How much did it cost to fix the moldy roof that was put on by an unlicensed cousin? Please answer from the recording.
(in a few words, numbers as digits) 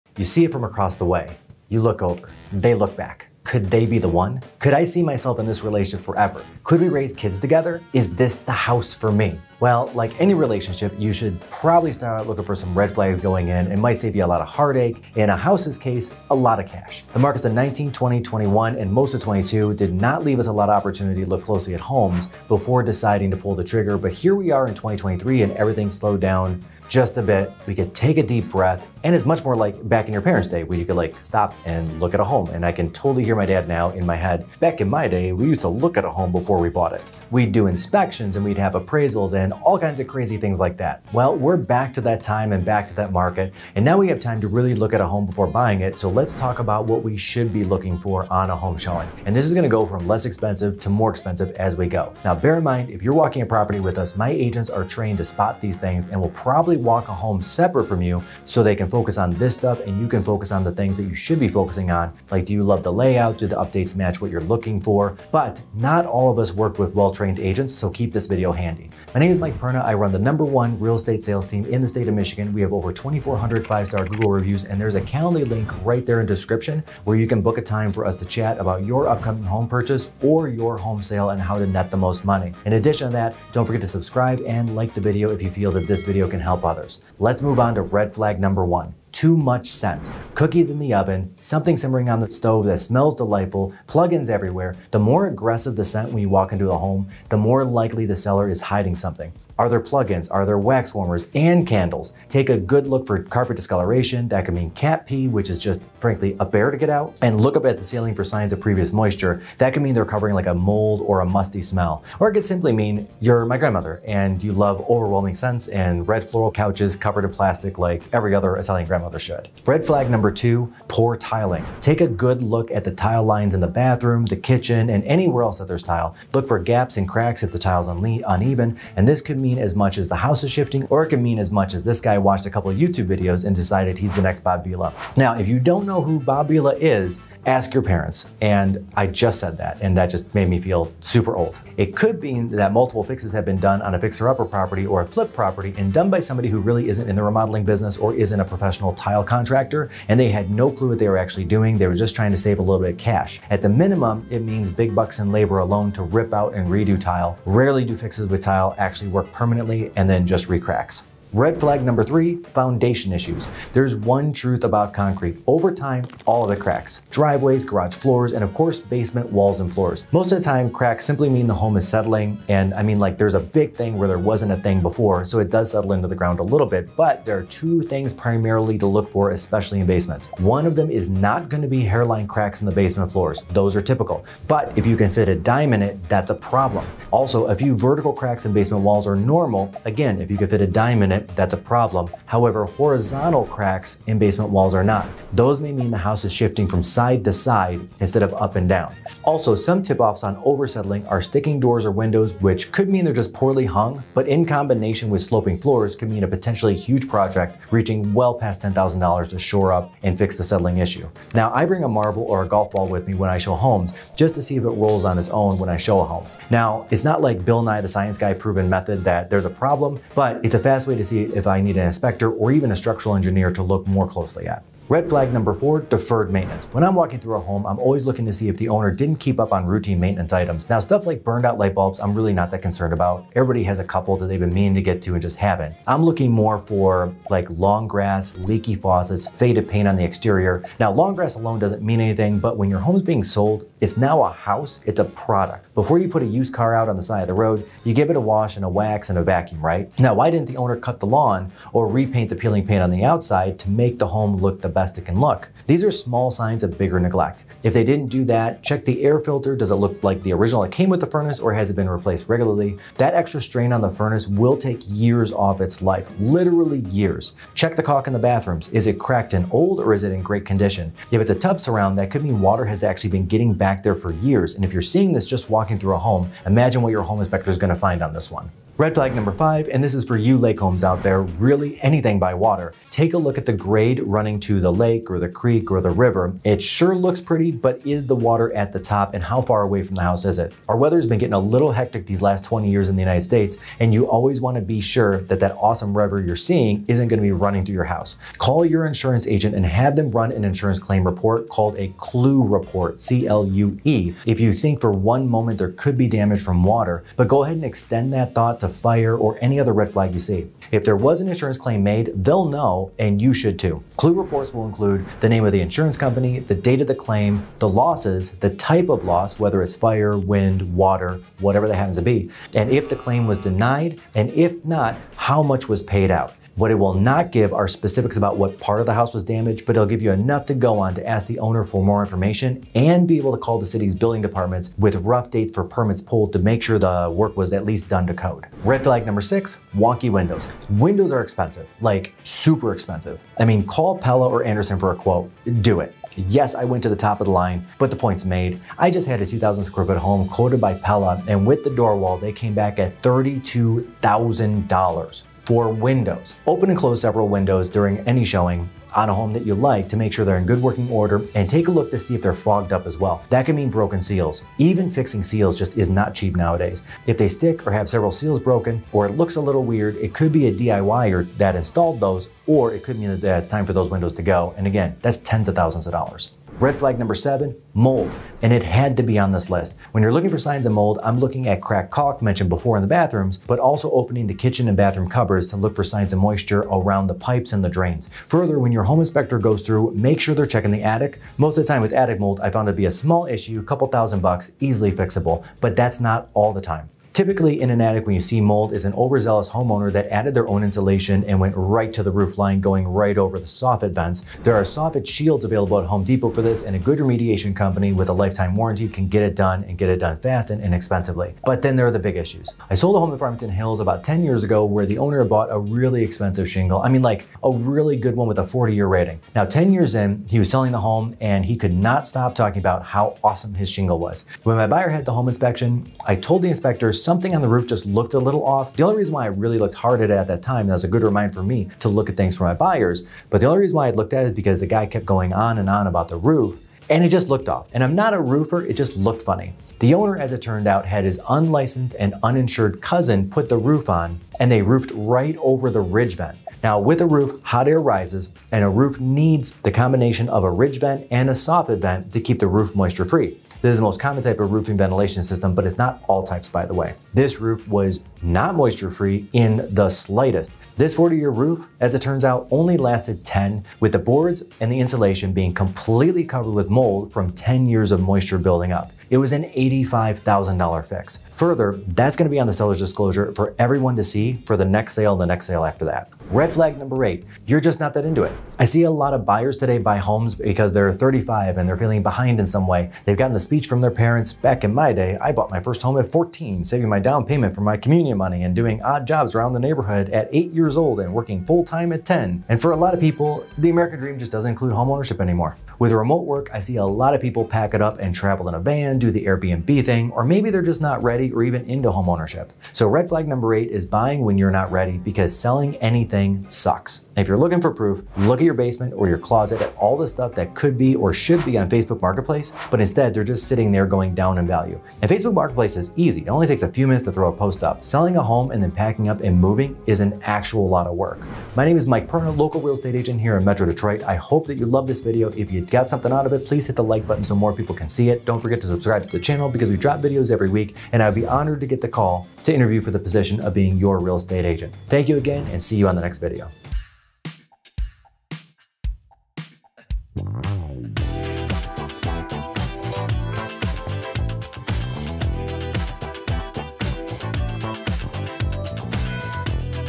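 $85,000.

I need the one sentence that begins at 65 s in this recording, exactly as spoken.
But not all of us work with well trained agents, so keep this video handy.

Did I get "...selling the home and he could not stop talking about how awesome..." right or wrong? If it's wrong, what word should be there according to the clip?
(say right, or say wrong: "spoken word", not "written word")
right.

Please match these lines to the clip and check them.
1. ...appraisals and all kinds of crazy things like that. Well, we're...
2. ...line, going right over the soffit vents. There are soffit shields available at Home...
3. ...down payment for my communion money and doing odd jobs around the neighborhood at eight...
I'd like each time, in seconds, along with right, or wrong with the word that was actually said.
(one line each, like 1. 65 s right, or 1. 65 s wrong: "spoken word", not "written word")
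1. 38 s right
2. 402 s right
3. 486 s right.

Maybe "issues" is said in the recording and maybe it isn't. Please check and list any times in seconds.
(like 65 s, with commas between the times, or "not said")
163 s, 210 s, 393 s, 412 s.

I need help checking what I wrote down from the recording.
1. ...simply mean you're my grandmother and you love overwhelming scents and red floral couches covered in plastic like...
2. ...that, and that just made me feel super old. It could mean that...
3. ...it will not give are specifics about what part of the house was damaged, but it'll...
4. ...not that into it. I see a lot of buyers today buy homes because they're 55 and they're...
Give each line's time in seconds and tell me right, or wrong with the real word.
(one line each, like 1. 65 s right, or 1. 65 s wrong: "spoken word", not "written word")
1. 112 s right
2. 139 s right
3. 326 s right
4. 477 s wrong: "35", not "55".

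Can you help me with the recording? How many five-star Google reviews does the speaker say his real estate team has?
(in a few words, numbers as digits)
over 2,400.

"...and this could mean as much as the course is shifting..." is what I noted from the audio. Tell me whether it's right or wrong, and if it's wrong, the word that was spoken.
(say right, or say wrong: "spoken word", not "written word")
wrong: "house", not "course".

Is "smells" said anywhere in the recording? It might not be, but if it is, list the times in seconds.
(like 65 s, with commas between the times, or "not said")
92 s, 111 s.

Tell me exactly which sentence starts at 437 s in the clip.
And I'm not a roofer, it just looked funny.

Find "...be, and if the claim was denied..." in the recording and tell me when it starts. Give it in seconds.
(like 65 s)
322 s.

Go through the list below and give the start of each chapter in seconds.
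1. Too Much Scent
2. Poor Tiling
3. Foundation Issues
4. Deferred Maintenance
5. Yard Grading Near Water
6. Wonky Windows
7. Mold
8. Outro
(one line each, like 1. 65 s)
1. 87 s
2. 119 s
3. 161 s
4. 224 s
5. 278 s
6. 338 s
7. 376 s
8. 521 s.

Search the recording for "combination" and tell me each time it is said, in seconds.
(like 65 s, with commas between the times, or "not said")
204 s, 449 s.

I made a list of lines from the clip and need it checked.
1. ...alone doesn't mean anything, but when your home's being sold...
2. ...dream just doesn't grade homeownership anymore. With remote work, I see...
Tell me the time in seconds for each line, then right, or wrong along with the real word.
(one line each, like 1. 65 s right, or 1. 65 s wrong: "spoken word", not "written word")
1. 241 s right
2. 493 s wrong: "include", not "grade".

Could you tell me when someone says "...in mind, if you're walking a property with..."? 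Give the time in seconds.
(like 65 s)
52 s.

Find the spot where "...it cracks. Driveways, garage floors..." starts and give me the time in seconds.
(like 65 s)
166 s.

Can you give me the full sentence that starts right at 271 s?
If it's a tub surround, that could mean water has actually been getting back there for years.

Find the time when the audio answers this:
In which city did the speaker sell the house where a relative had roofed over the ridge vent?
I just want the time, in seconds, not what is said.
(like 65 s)
413 s.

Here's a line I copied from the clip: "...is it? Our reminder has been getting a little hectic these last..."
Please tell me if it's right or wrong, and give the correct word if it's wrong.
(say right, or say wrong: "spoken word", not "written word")
wrong: "weather", not "reminder".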